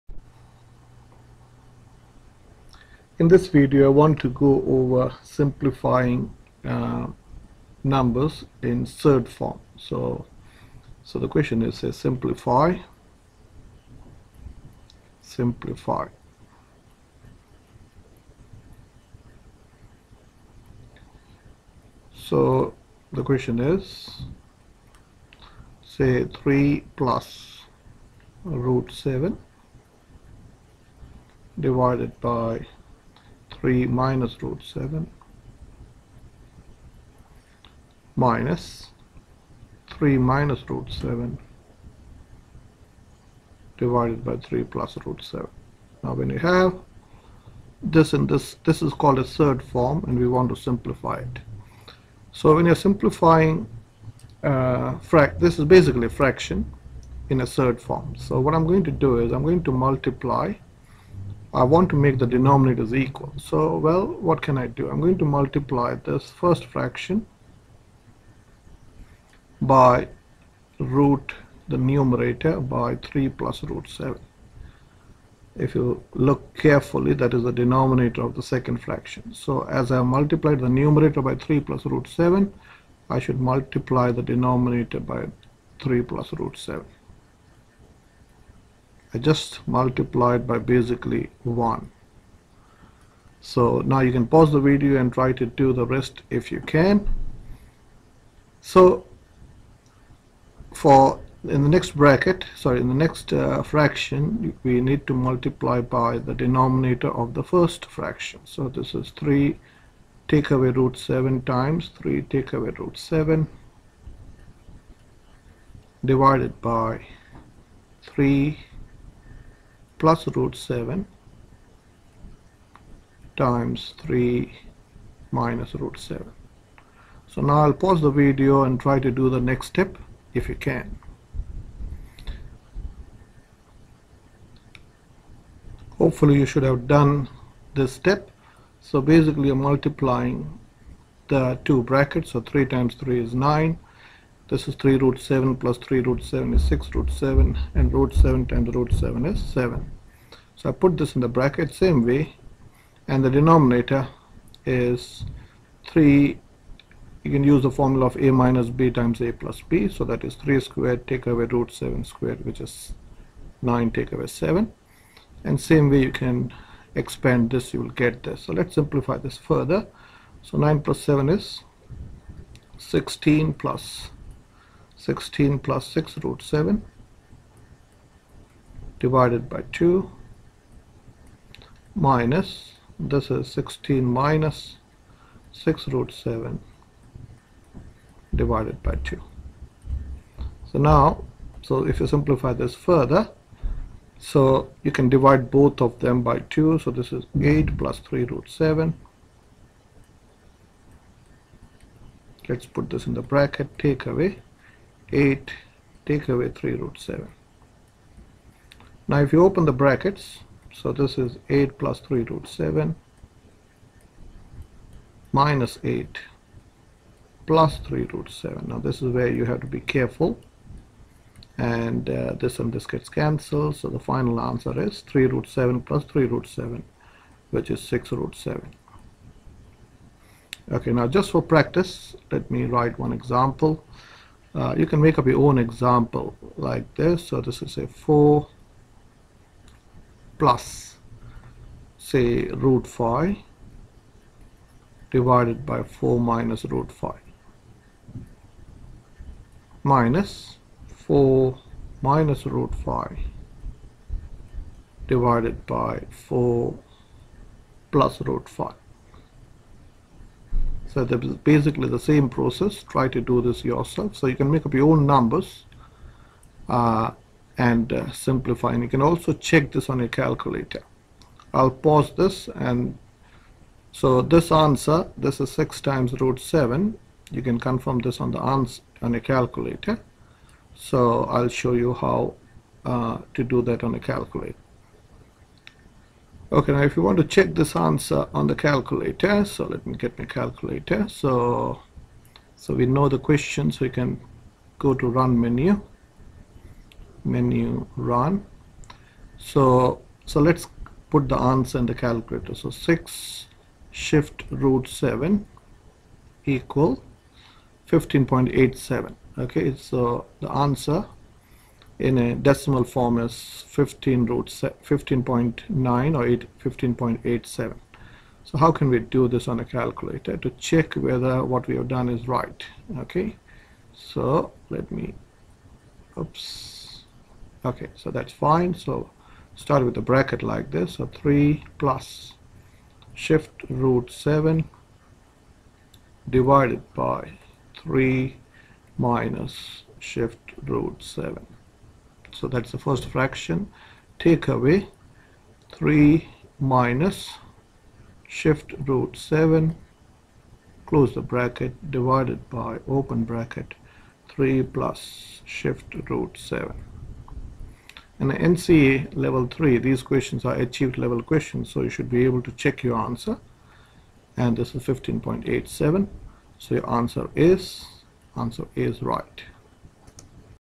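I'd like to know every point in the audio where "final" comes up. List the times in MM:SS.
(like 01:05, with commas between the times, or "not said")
03:43.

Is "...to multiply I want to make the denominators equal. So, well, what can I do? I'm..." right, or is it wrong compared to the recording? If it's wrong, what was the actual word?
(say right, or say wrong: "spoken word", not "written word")
right.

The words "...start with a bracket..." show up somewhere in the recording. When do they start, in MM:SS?
05:29.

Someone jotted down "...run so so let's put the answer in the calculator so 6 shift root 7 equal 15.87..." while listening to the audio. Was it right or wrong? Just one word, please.
right.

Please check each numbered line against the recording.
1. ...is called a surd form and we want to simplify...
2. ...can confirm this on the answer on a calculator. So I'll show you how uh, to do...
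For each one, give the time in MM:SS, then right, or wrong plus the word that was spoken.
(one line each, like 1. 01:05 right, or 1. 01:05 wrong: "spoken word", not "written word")
1. 00:48 right
2. 04:37 right.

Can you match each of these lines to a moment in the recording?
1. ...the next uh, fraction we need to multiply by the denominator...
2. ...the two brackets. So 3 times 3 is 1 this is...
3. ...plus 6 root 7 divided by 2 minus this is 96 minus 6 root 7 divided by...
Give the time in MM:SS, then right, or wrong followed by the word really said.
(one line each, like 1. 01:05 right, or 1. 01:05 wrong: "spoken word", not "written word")
1. 01:42 right
2. 02:21 wrong: "9", not "1"
3. 02:55 wrong: "16", not "96".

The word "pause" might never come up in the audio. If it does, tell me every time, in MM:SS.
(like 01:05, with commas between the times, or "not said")
01:34, 02:07, 04:31.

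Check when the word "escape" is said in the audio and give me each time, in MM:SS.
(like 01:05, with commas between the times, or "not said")
not said.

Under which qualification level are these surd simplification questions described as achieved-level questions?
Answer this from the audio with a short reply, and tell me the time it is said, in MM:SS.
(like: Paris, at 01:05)
NCEA level 3, at 05:58.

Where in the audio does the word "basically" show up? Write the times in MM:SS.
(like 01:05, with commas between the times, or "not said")
00:55, 01:30, 02:19, 04:21.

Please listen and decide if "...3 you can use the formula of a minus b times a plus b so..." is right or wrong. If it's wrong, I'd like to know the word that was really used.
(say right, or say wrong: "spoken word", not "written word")
right.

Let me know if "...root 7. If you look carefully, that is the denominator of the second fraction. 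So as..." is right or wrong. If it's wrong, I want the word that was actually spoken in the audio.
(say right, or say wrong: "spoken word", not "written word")
right.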